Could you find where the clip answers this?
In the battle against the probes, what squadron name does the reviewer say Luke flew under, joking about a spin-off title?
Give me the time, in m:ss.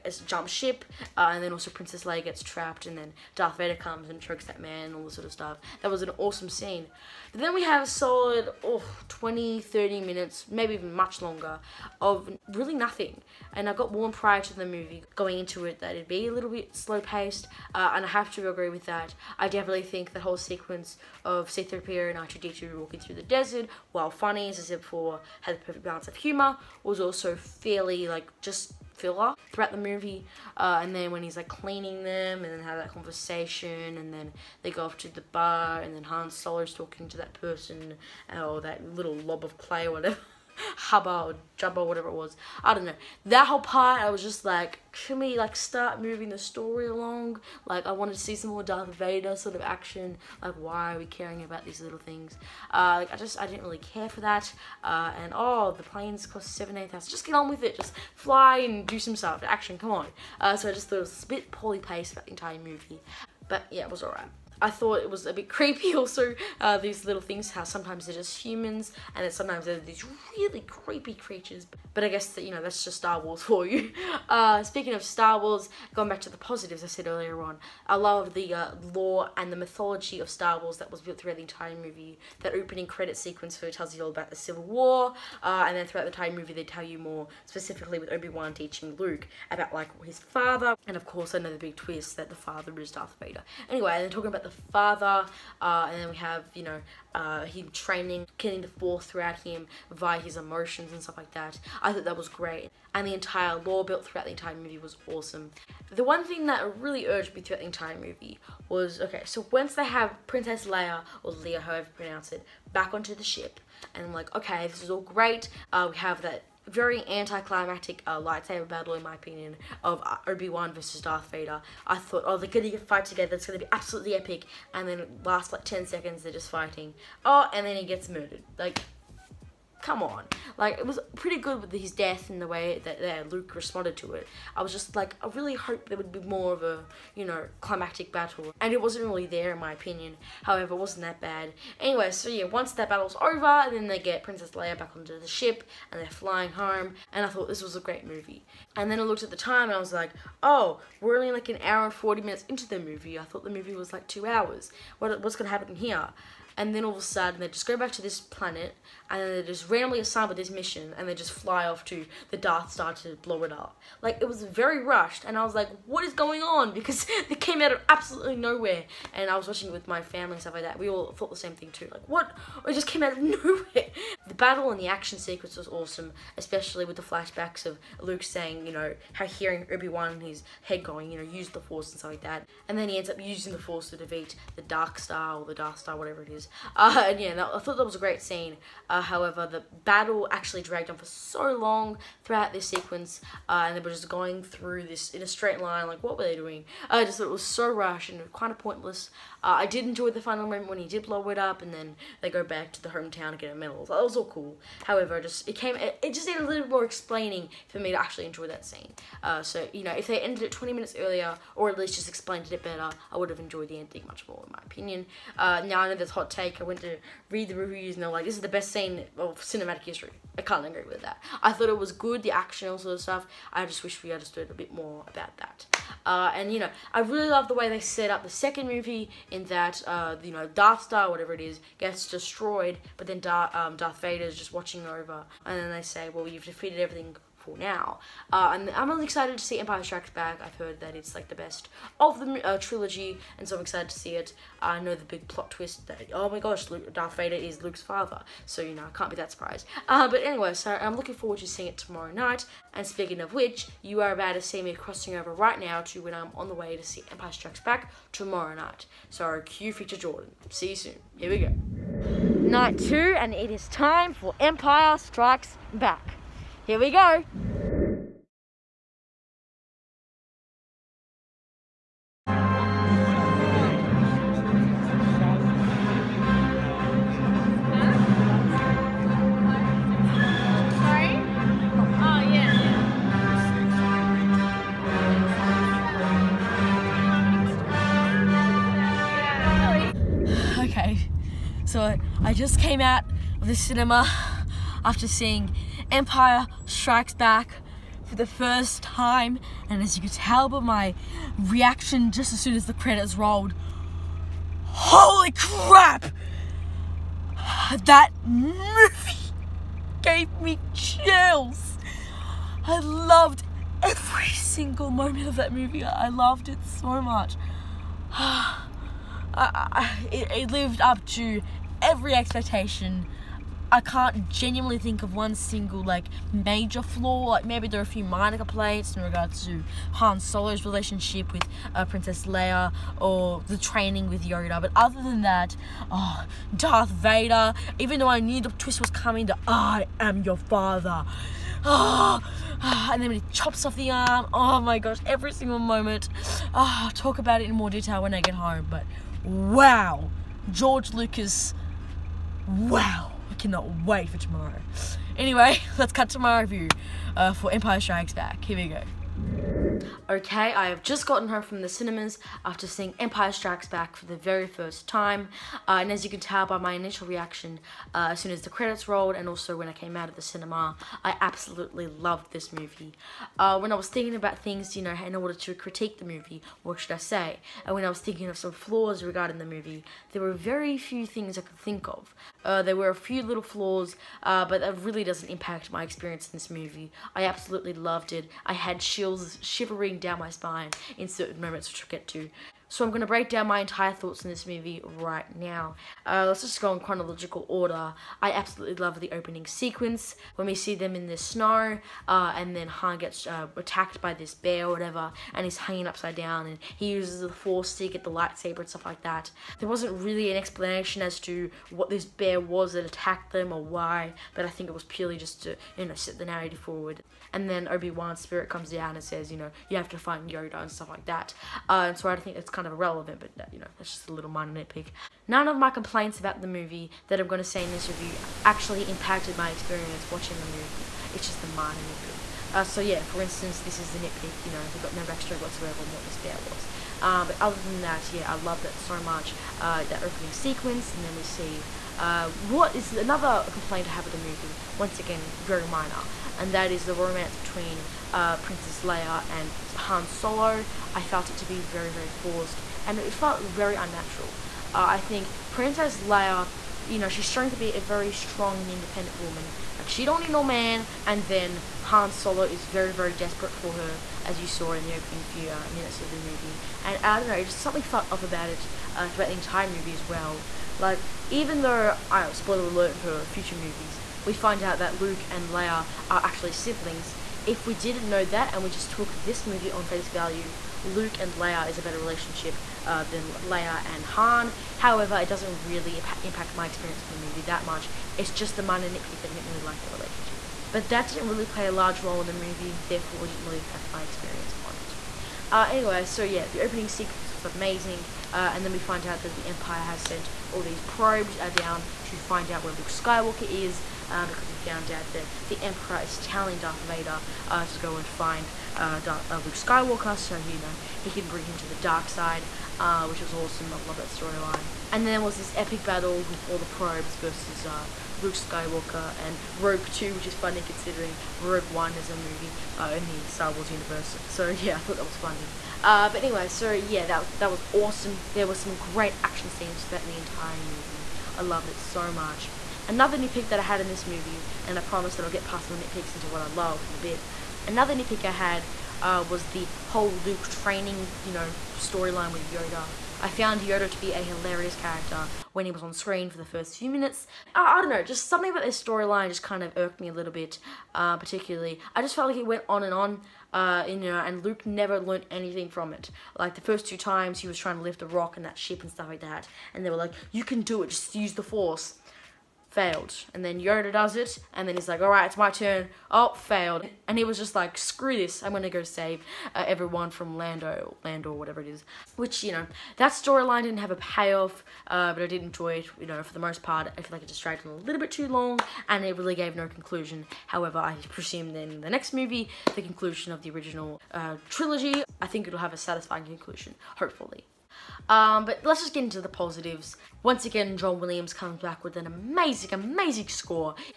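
8:39.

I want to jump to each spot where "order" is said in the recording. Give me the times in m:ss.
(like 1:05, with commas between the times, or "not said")
6:15, 6:37.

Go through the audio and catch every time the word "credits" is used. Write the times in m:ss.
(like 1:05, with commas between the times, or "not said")
1:22, 5:02, 6:08.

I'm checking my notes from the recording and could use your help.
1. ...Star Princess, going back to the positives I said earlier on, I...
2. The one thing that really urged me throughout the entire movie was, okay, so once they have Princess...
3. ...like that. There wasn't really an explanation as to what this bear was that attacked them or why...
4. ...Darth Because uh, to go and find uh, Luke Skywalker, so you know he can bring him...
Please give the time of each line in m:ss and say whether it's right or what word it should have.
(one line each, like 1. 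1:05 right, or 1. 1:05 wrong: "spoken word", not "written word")
1. 1:15 wrong: "Wars", not "Princess"
2. 1:45 right
3. 6:48 right
4. 8:26 wrong: "Vader", not "Because".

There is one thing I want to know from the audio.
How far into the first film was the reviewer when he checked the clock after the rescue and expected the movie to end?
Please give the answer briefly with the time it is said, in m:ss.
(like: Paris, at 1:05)
an hour and 40 minutes, at 2:31.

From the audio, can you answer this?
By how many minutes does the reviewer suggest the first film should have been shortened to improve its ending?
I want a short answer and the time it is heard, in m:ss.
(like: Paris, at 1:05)
20 minutes, at 3:30.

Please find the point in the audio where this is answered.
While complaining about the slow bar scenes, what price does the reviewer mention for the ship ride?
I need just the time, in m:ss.
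0:56.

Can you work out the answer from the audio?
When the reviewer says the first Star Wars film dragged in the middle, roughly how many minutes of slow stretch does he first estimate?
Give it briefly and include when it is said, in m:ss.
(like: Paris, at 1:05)
20, 30 minutes, at 0:09.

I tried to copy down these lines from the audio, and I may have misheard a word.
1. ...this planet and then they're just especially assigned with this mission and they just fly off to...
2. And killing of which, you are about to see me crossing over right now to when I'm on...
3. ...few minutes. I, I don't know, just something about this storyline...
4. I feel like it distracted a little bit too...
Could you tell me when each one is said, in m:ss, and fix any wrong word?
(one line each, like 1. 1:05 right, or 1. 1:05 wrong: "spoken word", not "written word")
1. 2:38 wrong: "randomly", not "especially"
2. 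4:12 wrong: "speaking", not "killing"
3. 9:06 right
4. 9:36 right.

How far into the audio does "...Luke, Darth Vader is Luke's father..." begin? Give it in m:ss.
4:06.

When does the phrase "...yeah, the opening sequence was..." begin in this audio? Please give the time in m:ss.
8:16.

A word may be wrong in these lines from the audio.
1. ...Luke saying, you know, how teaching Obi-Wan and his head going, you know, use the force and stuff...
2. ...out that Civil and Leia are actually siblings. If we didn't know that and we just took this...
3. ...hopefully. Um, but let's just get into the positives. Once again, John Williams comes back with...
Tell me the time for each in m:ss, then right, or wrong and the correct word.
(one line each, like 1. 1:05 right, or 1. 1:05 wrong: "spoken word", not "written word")
1. 2:58 wrong: "hearing", not "teaching"
2. 7:54 wrong: "Luke", not "Civil"
3. 9:46 right.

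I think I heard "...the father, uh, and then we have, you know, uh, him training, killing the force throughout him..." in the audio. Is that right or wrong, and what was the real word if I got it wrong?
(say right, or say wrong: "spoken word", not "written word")
right.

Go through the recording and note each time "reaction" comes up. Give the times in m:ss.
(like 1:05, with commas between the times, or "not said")
5:01, 6:07.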